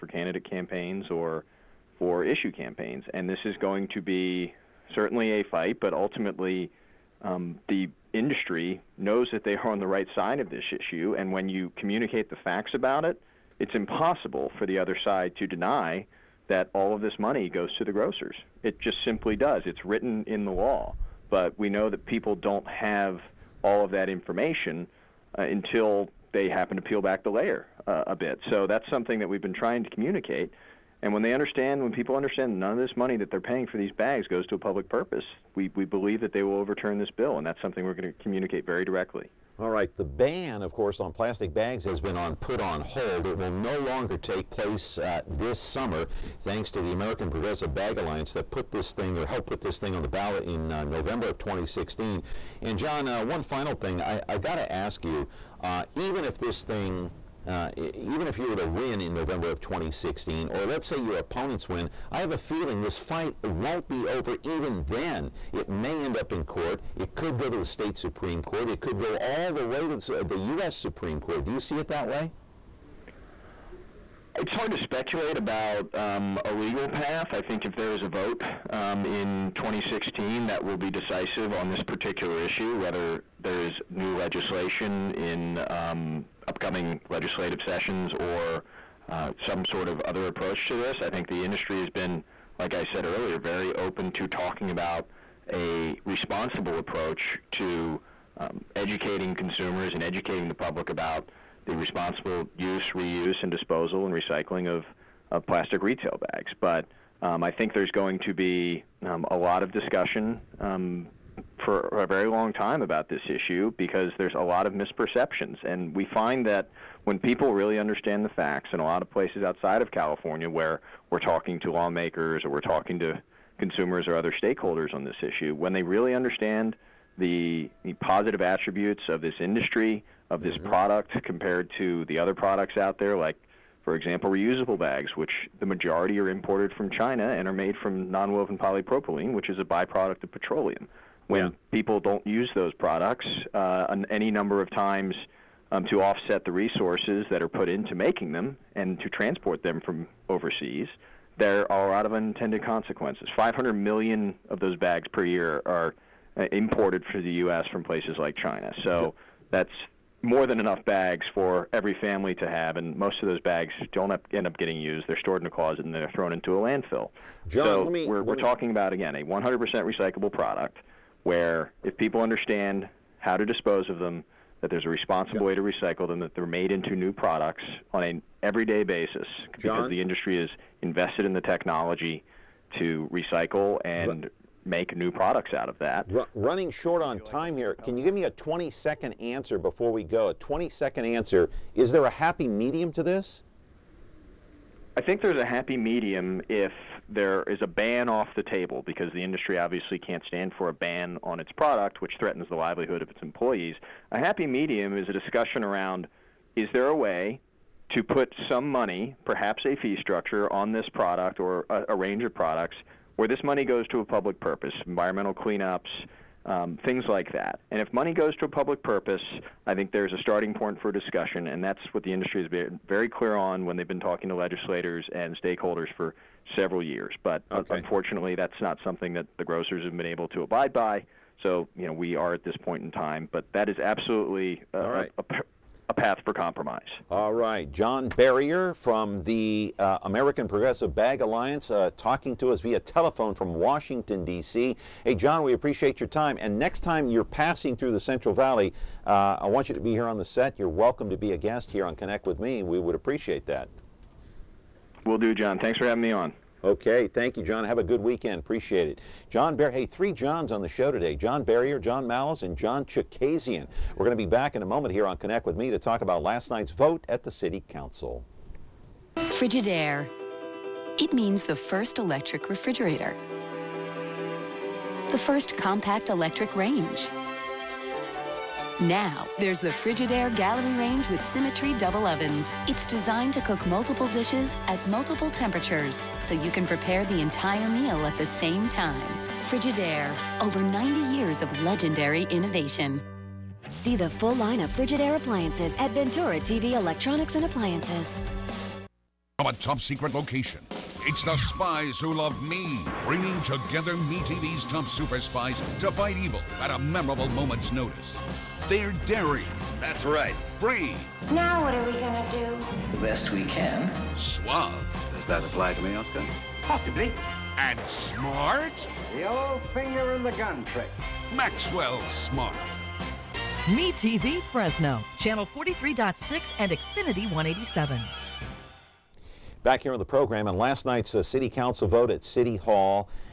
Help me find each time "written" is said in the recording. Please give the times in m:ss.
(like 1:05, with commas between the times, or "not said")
0:19.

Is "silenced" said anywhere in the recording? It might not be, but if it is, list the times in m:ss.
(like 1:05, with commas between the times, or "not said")
not said.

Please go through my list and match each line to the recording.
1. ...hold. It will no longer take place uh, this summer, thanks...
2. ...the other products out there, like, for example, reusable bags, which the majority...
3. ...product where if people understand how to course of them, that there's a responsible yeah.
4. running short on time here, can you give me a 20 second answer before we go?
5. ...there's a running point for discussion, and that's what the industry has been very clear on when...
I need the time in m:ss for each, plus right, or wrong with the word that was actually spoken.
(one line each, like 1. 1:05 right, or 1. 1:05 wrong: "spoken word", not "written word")
1. 0:42 right
2. 2:12 right
3. 2:50 wrong: "dispose", not "course"
4. 3:06 right
5. 3:39 wrong: "starting", not "running".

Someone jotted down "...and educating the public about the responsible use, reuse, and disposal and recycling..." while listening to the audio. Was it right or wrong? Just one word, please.
right.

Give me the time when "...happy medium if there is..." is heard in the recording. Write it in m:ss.
3:15.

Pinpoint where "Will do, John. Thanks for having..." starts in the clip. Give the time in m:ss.
4:15.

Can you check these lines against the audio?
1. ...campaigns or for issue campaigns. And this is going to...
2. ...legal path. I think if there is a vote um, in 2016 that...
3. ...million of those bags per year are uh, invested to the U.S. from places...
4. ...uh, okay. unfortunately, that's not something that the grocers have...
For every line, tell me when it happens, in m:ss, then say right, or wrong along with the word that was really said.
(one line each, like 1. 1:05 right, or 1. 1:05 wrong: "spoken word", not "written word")
1. 0:00 right
2. 1:16 right
3. 2:33 wrong: "imported", not "invested"
4. 3:47 right.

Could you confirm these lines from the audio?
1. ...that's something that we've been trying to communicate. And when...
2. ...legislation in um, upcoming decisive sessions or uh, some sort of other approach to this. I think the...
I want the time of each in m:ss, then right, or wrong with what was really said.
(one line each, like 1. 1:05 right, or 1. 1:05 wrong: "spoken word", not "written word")
1. 0:28 right
2. 1:24 wrong: "legislative", not "decisive".